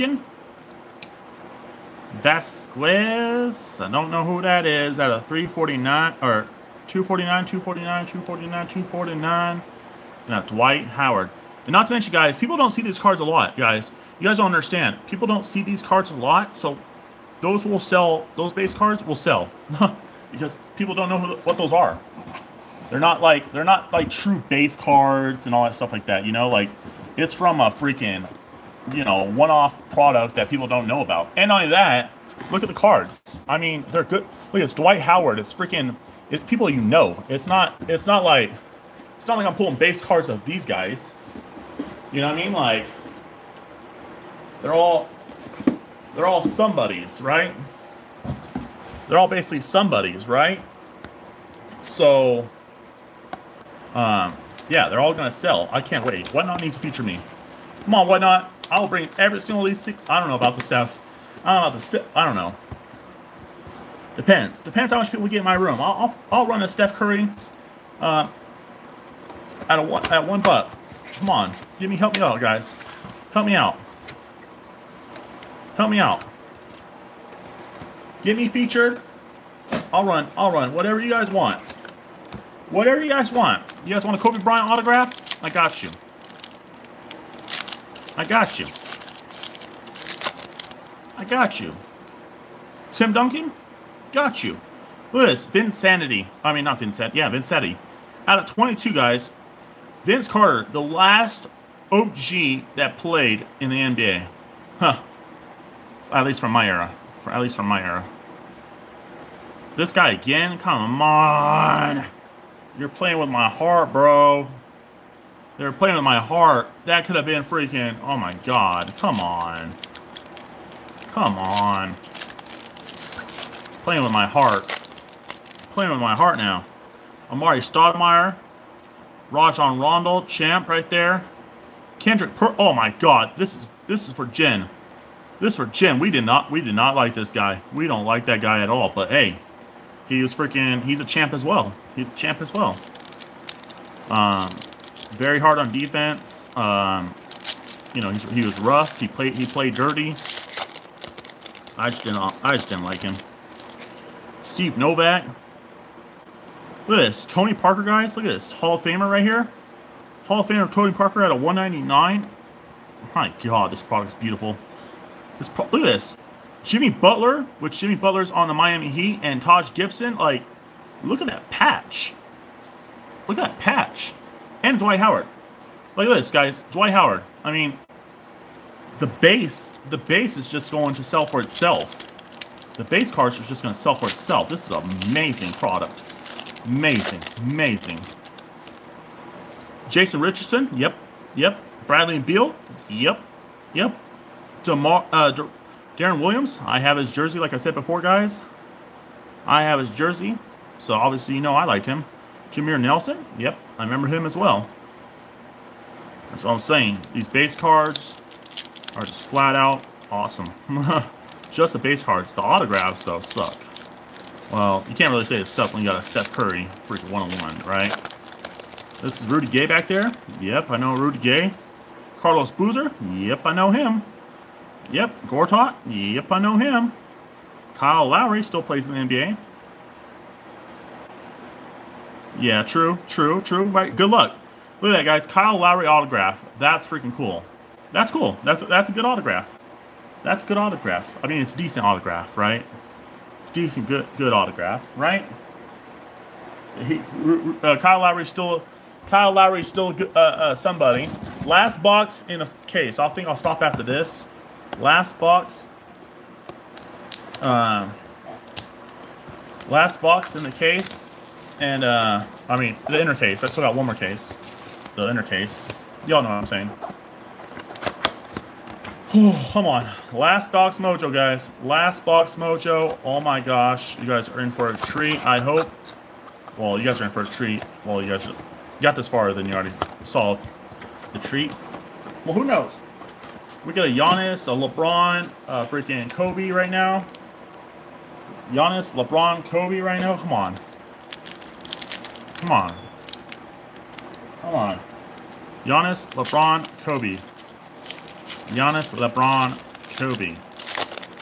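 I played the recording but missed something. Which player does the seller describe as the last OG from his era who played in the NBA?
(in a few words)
Vince Carter.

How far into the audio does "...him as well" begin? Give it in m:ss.
3:24.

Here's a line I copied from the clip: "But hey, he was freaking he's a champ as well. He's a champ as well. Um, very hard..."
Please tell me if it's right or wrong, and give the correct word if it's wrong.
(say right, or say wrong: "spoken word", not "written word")
right.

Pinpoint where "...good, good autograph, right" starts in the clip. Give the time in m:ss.
4:03.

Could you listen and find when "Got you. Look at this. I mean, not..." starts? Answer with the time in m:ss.
1:34.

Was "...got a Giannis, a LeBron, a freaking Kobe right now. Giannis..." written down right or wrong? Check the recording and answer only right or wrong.
right.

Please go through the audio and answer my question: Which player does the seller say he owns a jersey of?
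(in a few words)
Deron Williams.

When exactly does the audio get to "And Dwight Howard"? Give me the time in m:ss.
2:54.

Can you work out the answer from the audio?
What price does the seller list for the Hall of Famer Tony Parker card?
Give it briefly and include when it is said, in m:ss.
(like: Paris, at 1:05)
199, at 2:41.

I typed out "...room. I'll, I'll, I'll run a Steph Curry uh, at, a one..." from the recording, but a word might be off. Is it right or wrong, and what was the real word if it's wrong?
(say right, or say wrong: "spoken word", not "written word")
right.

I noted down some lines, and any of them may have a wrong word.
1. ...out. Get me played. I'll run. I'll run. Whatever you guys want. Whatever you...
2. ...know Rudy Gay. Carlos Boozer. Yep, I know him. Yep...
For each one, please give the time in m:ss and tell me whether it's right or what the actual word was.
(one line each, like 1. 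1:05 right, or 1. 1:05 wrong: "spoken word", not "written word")
1. 1:15 wrong: "featured", not "played"
2. 3:40 right.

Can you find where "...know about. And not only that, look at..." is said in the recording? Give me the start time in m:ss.
0:30.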